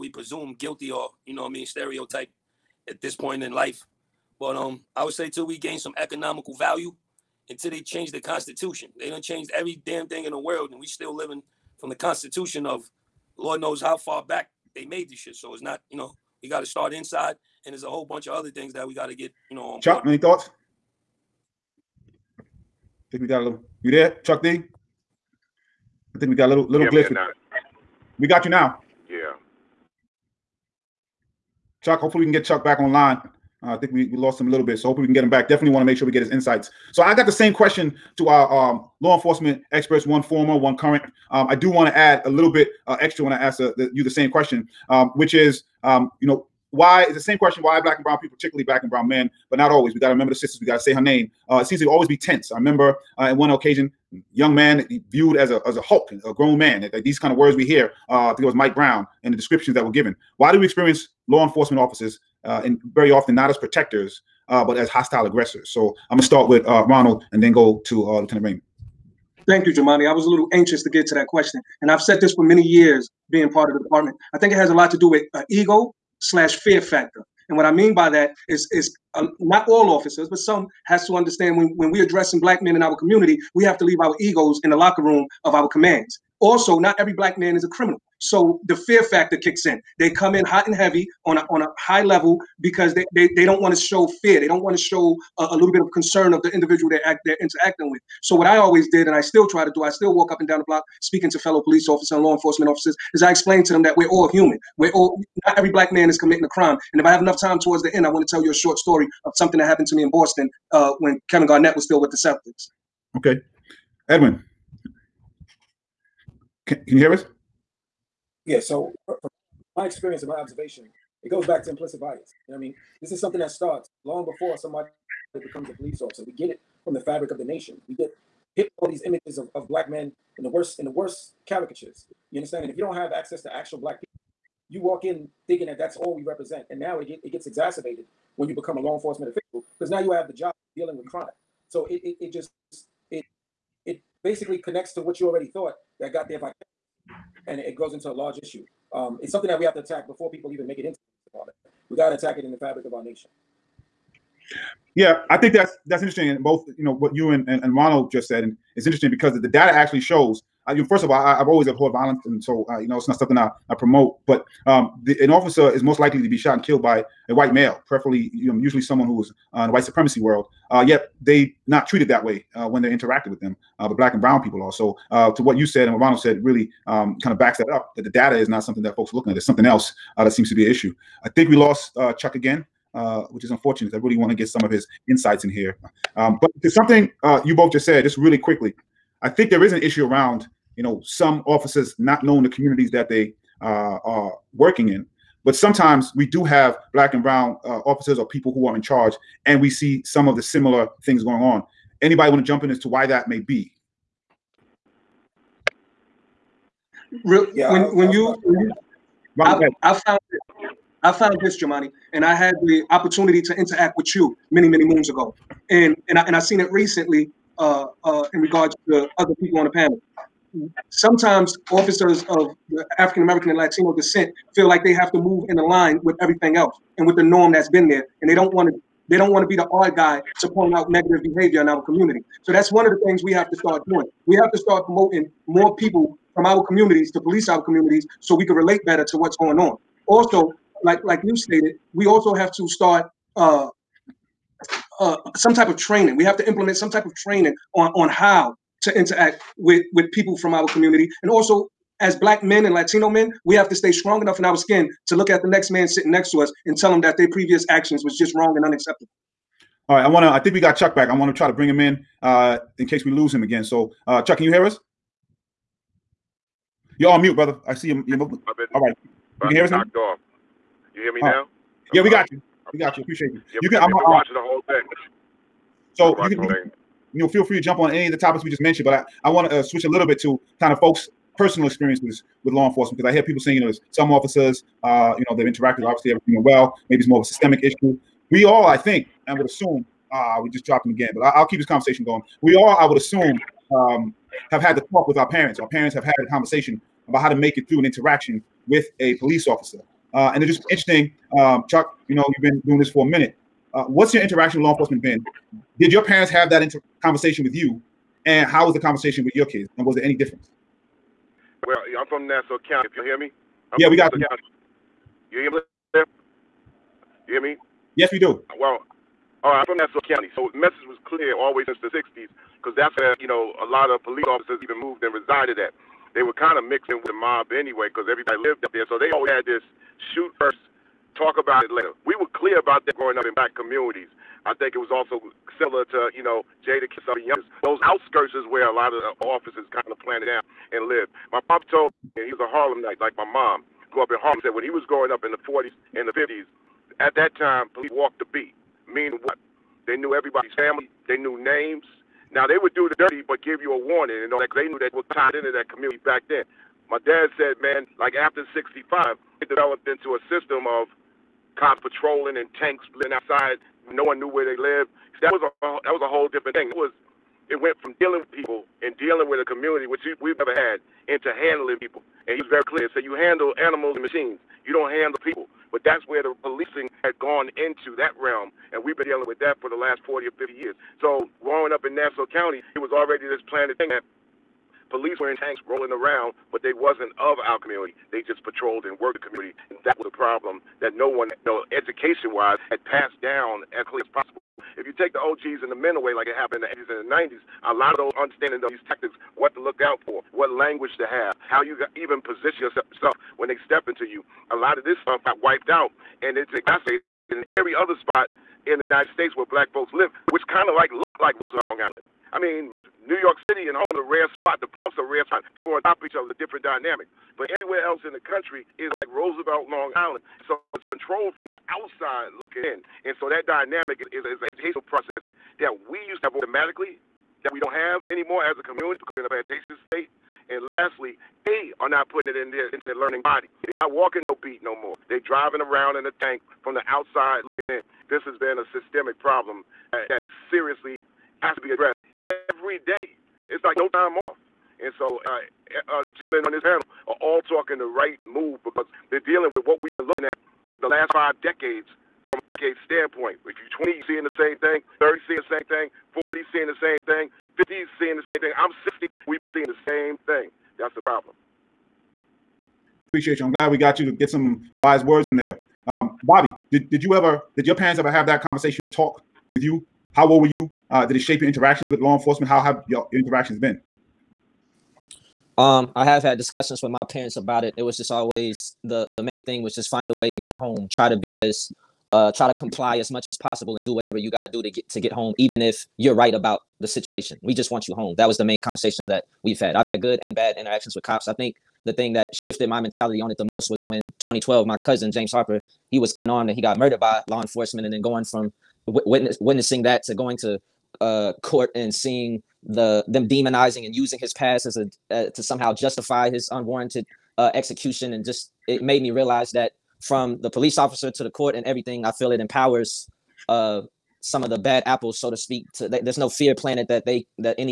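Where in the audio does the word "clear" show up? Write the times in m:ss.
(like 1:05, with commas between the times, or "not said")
5:21, 5:32, 6:12, 6:33.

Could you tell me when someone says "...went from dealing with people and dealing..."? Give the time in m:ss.
6:07.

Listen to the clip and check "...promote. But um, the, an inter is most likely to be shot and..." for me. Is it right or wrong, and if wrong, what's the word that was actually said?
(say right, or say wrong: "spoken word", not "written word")
wrong: "officer", not "inter".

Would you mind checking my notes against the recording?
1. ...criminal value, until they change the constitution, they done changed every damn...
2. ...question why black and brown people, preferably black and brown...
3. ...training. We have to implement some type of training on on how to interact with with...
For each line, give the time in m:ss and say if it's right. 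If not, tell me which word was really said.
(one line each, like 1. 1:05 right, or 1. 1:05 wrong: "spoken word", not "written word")
1. 0:05 wrong: "economical", not "criminal"
2. 0:47 wrong: "particularly", not "preferably"
3. 4:05 right.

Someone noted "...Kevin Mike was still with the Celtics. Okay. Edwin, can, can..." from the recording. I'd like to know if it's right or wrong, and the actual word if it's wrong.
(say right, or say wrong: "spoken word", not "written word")
wrong: "Garnett", not "Mike".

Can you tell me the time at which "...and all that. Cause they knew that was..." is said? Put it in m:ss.
5:54.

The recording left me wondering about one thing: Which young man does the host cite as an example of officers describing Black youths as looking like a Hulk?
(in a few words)
Mike Brown.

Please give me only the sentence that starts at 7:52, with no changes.
How have your, your interactions been?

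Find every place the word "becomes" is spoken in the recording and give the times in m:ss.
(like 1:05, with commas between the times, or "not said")
2:05, 2:18.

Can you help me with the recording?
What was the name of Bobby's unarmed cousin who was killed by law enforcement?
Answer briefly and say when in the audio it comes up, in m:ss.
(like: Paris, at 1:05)
James Harper, at 8:15.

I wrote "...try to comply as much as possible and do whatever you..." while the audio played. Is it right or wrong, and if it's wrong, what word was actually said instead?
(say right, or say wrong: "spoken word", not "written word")
right.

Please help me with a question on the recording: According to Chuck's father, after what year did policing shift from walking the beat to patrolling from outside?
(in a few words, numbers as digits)
1965.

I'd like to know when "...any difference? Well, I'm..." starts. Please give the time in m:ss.
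5:10.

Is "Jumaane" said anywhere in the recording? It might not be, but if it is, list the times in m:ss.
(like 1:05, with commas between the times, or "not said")
1:09, 3:31.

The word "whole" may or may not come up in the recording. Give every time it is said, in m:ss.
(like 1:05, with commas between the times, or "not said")
0:17, 4:34, 6:06.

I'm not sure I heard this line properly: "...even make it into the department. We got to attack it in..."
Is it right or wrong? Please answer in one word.
right.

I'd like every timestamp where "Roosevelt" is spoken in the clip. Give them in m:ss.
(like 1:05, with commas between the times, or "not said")
6:51, 6:59.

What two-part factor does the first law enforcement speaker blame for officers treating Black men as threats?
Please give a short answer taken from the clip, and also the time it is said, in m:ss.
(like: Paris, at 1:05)
ego slash fear factor, at 1:15.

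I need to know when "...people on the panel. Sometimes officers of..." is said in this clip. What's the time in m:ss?
3:39.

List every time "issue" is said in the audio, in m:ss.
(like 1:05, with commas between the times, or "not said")
2:28, 3:00, 3:09, 4:47.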